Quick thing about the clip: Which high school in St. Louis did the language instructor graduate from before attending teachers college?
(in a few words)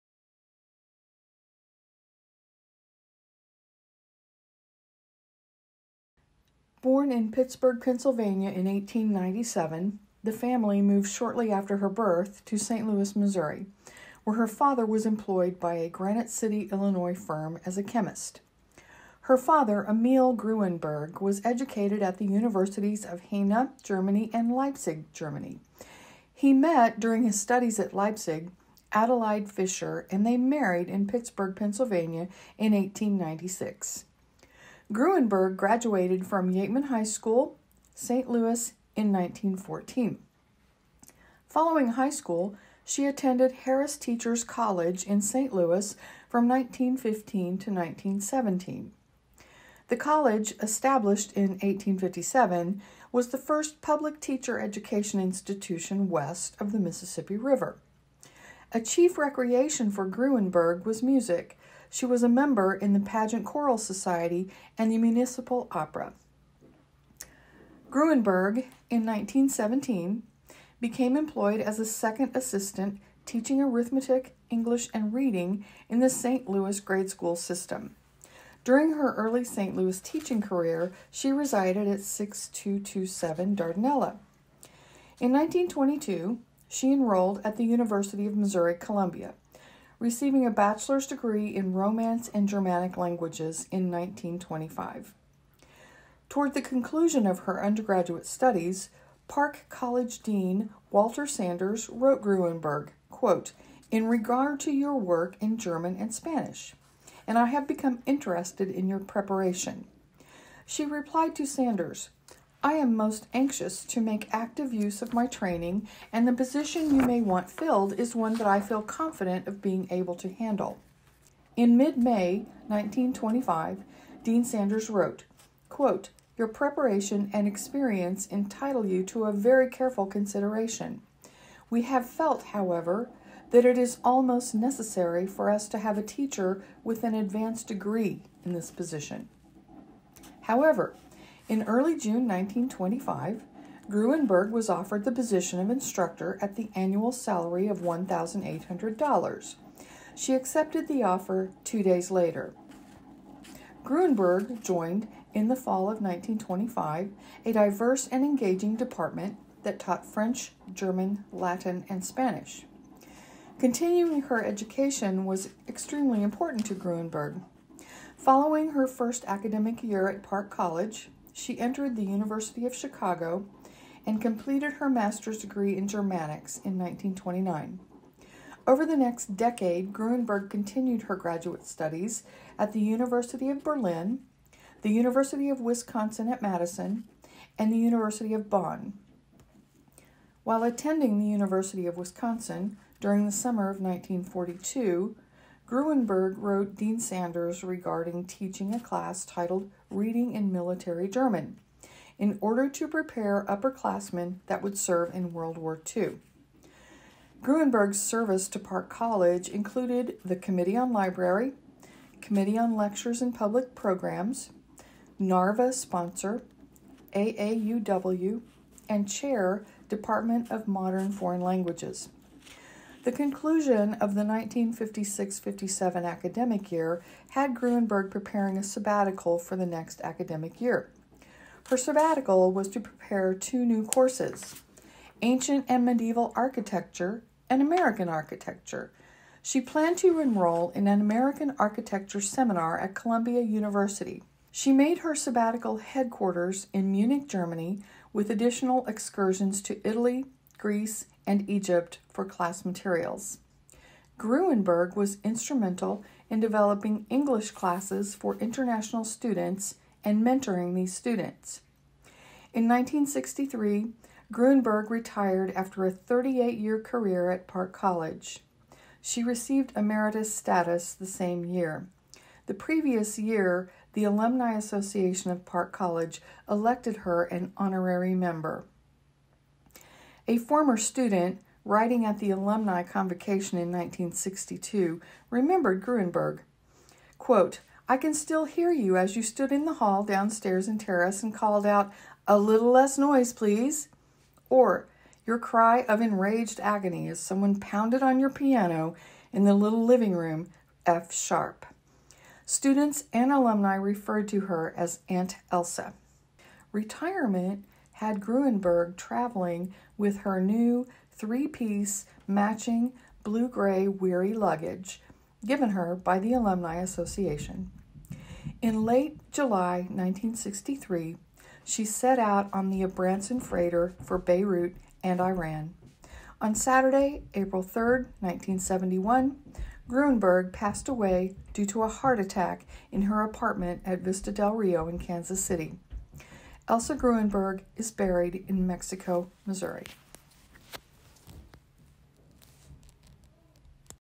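Yeatman High School.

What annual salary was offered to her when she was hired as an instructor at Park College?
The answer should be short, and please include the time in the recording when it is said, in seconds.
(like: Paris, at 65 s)
$1,800, at 147 s.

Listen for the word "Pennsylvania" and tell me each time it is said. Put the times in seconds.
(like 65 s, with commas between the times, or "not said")
7 s, 31 s.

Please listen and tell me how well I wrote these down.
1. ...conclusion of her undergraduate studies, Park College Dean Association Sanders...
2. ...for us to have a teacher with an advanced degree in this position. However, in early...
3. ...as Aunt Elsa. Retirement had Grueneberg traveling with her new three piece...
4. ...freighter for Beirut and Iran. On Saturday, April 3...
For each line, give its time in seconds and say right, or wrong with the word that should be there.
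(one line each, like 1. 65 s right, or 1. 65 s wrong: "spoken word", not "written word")
1. 96 s wrong: "Walter", not "Association"
2. 135 s right
3. 304 s right
4. 323 s right.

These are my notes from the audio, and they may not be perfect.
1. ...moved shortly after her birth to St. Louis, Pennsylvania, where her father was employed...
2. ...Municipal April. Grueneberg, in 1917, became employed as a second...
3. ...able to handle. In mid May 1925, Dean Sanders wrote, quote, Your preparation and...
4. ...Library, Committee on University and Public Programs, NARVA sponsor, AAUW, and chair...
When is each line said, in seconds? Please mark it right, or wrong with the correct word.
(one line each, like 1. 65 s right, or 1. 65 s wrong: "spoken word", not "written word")
1. 10 s wrong: "Missouri", not "Pennsylvania"
2. 64 s wrong: "Opera", not "April"
3. 119 s right
4. 210 s wrong: "Lectures", not "University".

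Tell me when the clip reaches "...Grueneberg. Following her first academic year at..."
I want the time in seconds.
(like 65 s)
166 s.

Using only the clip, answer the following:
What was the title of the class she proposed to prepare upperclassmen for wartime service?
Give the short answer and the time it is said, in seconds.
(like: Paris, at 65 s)
Reading in Military German, at 199 s.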